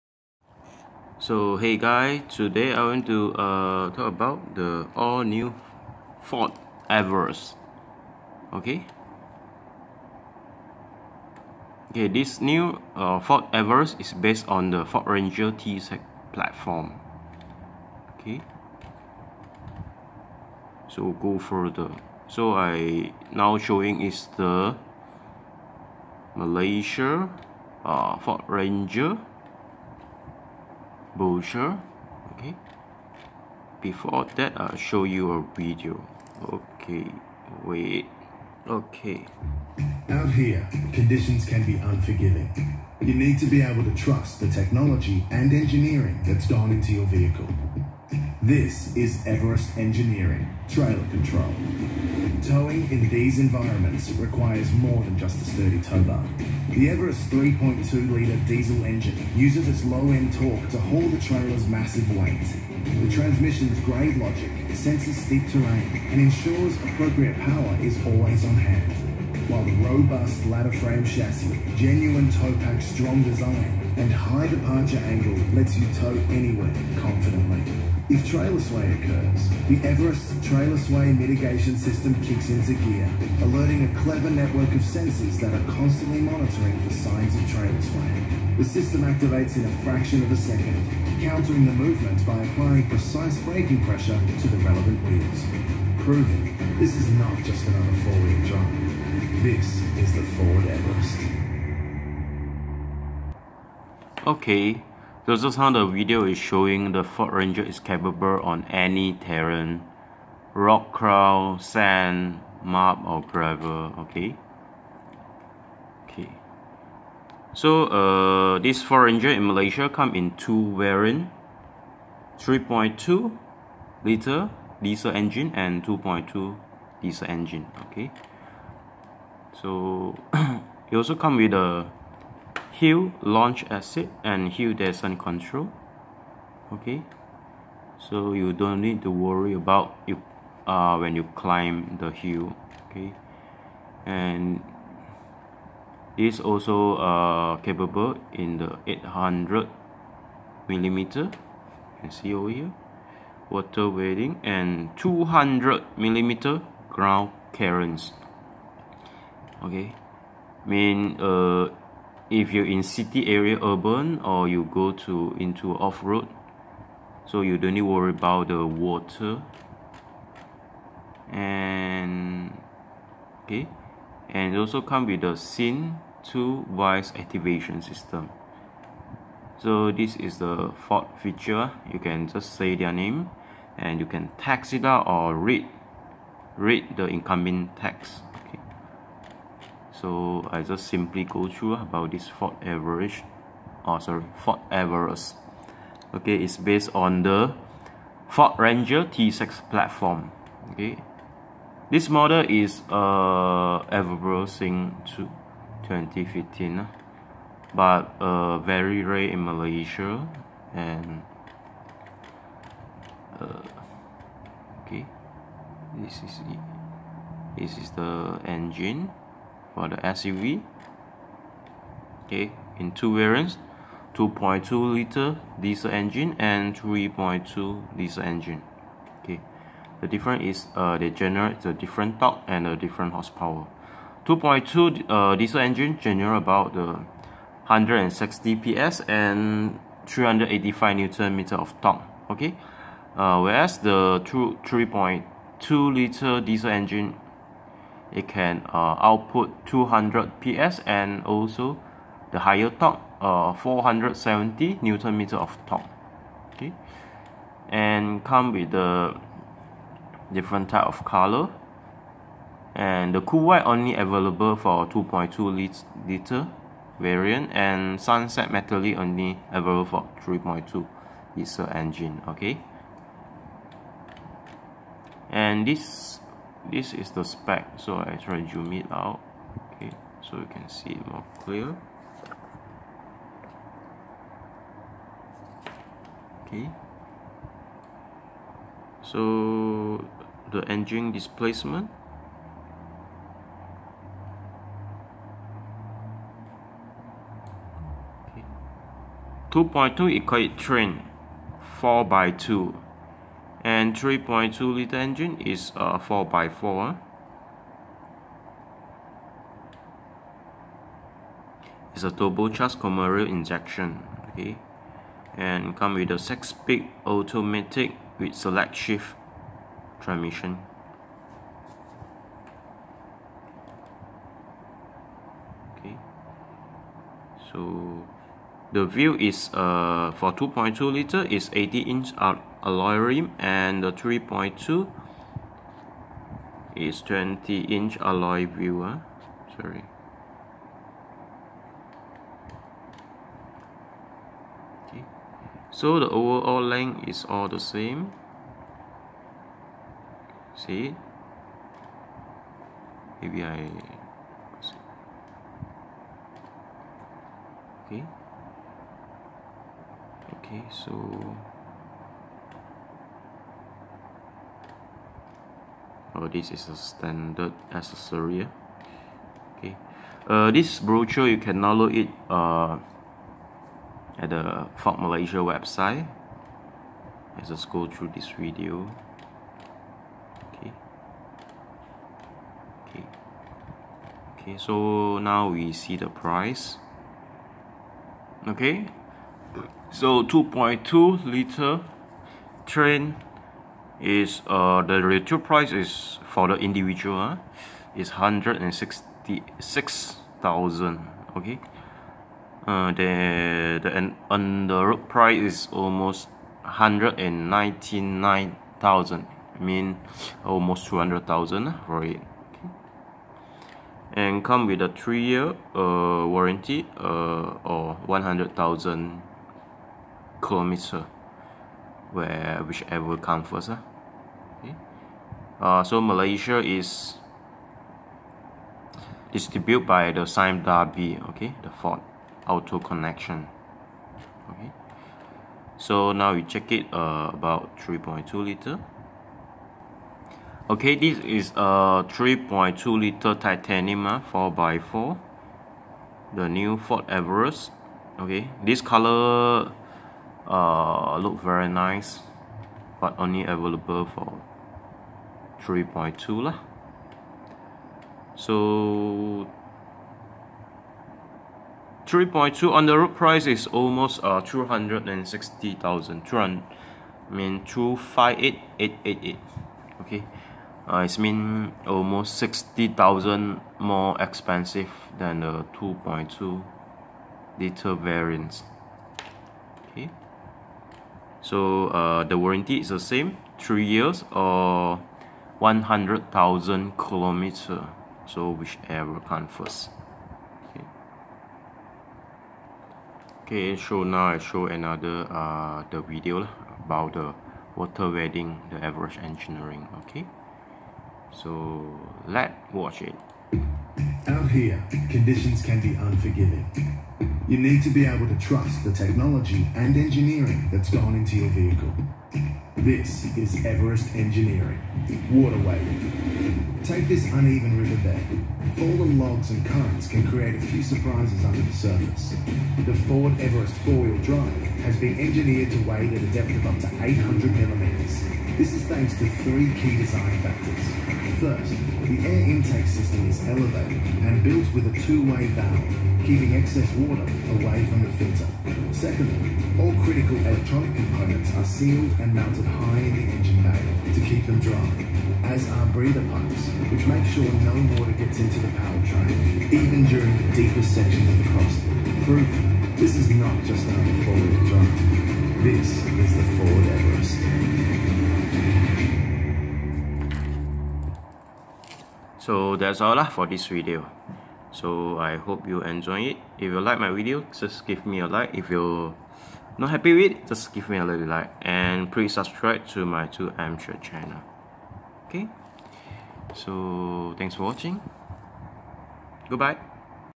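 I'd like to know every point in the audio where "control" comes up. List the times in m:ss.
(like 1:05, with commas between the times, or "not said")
0:51, 2:15.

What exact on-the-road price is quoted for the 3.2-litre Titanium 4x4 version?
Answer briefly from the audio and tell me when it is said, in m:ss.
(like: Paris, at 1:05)
258,888, at 7:47.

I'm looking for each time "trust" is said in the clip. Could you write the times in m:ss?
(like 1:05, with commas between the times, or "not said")
0:43, 8:28.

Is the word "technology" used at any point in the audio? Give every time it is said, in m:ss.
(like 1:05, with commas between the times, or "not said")
0:44, 8:28.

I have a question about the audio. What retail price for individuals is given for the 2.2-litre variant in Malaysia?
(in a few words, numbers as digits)
166,000.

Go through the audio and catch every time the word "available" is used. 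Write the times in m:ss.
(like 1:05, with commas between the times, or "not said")
4:23, 4:29, 7:33.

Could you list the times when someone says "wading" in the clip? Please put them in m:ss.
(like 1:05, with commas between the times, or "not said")
2:33, 8:18.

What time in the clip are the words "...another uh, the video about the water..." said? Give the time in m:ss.
8:14.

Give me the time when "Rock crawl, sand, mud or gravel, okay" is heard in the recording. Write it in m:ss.
1:50.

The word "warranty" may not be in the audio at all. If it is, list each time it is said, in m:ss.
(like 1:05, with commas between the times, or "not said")
6:56, 8:02.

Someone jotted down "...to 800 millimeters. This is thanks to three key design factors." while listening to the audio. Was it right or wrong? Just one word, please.
right.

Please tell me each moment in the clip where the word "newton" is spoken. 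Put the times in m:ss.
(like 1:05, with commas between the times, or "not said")
4:00, 4:14.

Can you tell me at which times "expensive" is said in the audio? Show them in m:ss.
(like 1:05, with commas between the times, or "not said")
7:54.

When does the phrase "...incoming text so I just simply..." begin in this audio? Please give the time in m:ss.
3:07.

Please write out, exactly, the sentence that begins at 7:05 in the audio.
Uh, so Malaysia is distributed by the Sime Darby, okay, the Ford Auto Connection.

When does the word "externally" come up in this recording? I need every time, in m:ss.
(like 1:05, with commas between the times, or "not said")
not said.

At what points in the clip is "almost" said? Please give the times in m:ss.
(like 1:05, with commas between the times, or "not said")
6:45, 6:50, 7:43, 7:51.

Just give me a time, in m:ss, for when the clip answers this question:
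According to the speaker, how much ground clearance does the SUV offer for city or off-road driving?
2:34.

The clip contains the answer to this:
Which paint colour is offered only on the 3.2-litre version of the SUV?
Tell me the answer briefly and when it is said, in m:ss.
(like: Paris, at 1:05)
Sunset metallic, at 4:27.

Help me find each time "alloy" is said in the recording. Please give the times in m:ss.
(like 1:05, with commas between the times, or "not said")
5:32, 5:37.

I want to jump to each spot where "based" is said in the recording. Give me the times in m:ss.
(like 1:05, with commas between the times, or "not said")
0:14, 3:16.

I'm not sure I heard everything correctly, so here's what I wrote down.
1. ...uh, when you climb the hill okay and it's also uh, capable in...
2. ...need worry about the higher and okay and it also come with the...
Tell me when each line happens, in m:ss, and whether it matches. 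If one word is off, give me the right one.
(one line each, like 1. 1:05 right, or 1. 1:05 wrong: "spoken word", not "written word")
1. 2:20 right
2. 2:47 wrong: "water", not "higher".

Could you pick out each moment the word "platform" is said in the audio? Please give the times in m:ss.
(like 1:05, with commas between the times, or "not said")
0:16, 3:19.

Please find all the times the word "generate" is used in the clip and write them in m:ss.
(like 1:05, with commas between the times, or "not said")
3:51, 3:55.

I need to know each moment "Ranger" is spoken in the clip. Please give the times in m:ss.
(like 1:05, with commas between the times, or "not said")
0:15, 0:28, 1:47, 1:59, 3:18.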